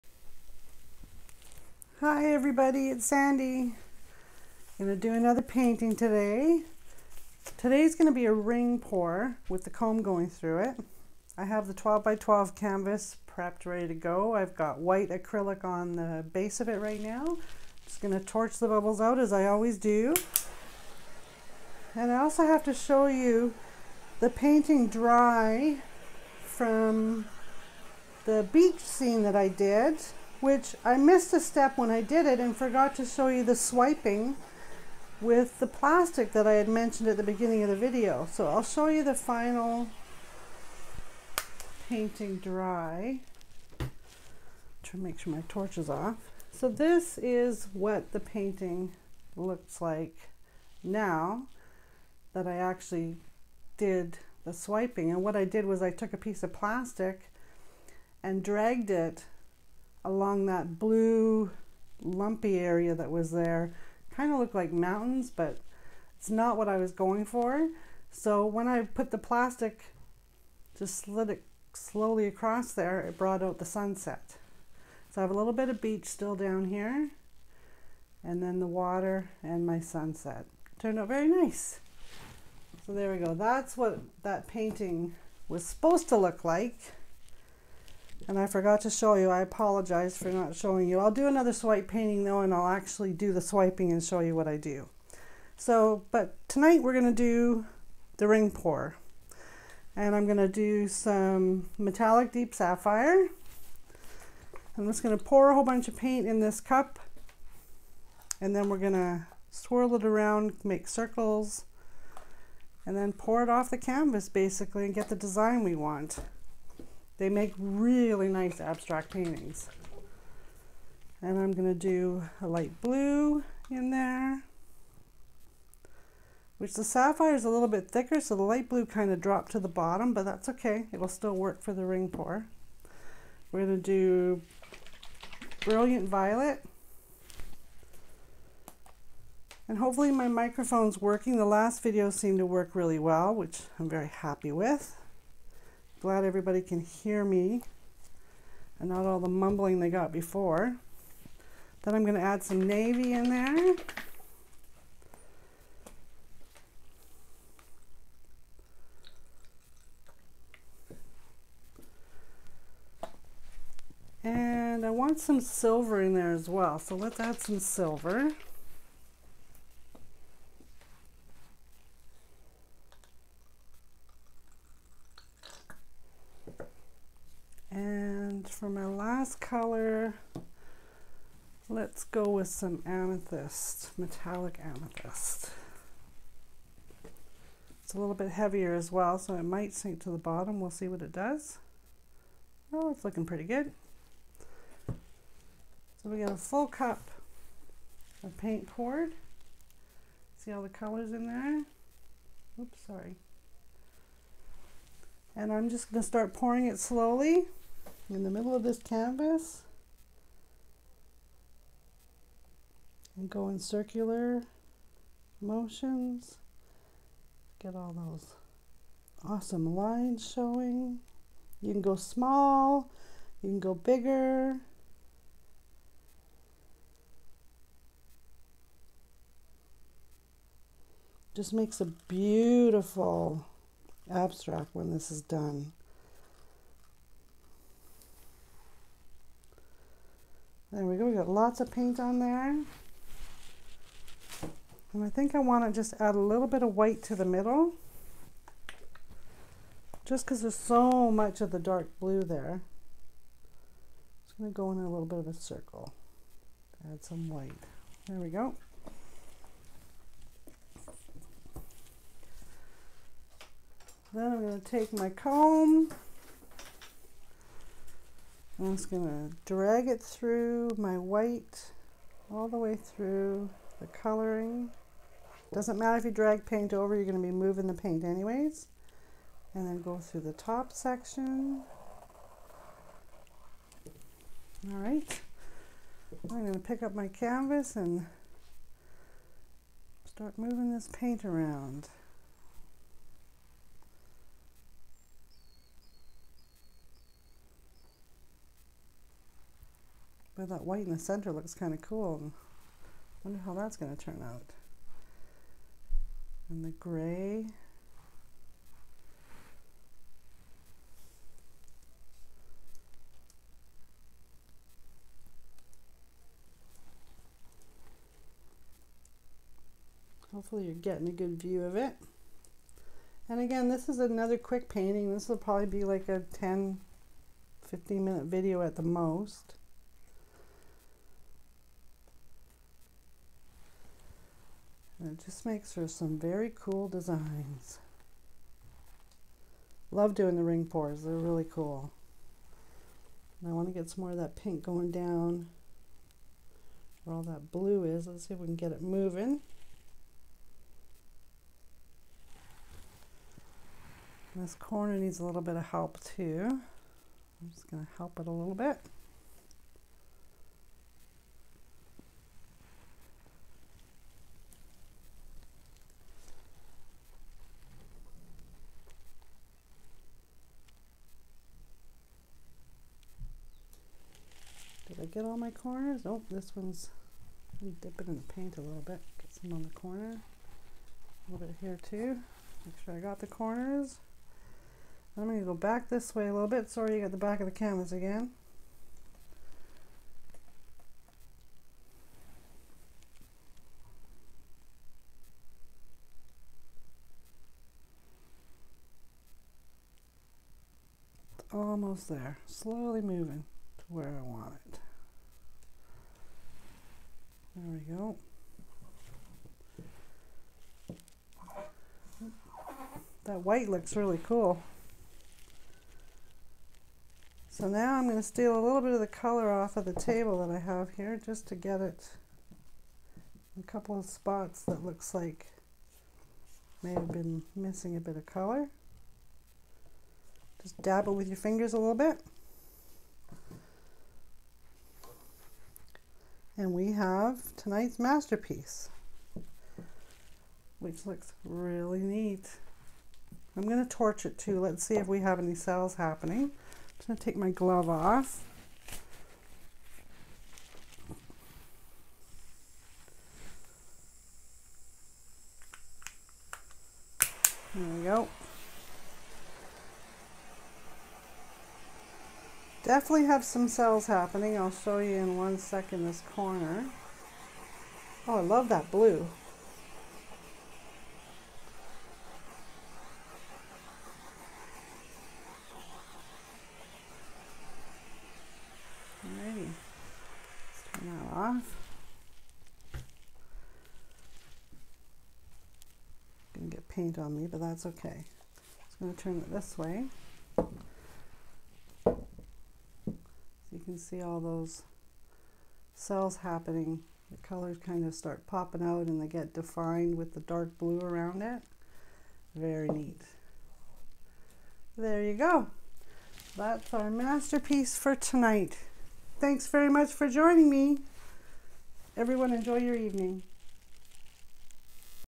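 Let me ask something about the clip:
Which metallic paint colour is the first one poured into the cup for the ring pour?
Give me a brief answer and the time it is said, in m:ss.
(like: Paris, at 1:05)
deep sapphire, at 1:41.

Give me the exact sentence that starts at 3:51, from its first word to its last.
Just makes a beautiful abstract when this is done.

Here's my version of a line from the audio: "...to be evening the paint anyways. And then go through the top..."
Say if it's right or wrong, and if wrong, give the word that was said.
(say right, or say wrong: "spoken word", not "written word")
wrong: "moving", not "evening".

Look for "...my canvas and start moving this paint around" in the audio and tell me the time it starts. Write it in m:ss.
4:46.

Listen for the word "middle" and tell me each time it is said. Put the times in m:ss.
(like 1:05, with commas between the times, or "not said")
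3:28, 4:07.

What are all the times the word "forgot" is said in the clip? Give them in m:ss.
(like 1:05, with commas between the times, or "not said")
0:32, 1:28.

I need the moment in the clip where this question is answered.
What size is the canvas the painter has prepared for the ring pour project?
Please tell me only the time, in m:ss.
0:11.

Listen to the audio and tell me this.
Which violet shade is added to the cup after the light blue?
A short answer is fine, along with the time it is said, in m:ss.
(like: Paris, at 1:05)
Brilliant Violet, at 2:15.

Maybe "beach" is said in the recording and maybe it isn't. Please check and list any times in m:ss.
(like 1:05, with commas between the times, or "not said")
0:28, 1:15.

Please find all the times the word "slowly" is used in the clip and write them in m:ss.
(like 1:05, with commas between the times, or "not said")
1:11, 3:26, 6:42.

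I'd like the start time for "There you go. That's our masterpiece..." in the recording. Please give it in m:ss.
8:24.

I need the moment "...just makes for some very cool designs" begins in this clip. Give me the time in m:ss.
5:35.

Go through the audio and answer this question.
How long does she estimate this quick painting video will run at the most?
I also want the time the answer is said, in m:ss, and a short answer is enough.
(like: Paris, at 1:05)
10 to 15 minutes, at 5:26.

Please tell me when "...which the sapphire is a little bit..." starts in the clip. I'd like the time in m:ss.
2:06.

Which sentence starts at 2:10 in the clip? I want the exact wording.
It'll still work for the ring pour.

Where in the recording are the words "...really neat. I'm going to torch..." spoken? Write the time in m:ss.
7:21.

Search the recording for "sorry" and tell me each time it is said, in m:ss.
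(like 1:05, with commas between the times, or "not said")
3:22, 6:26.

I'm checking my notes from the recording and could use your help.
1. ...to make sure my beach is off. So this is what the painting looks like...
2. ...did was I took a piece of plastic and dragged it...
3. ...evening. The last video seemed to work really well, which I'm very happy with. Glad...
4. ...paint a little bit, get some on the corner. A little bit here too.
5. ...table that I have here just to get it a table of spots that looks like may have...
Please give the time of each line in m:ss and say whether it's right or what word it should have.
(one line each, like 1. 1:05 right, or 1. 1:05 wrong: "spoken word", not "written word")
1. 0:44 wrong: "torch", not "beach"
2. 0:55 right
3. 2:20 wrong: "working", not "evening"
4. 6:18 right
5. 6:59 wrong: "couple", not "table".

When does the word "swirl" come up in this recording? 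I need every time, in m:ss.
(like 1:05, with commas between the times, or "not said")
1:49.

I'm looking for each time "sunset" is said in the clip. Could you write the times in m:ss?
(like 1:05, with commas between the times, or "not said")
1:13, 1:19.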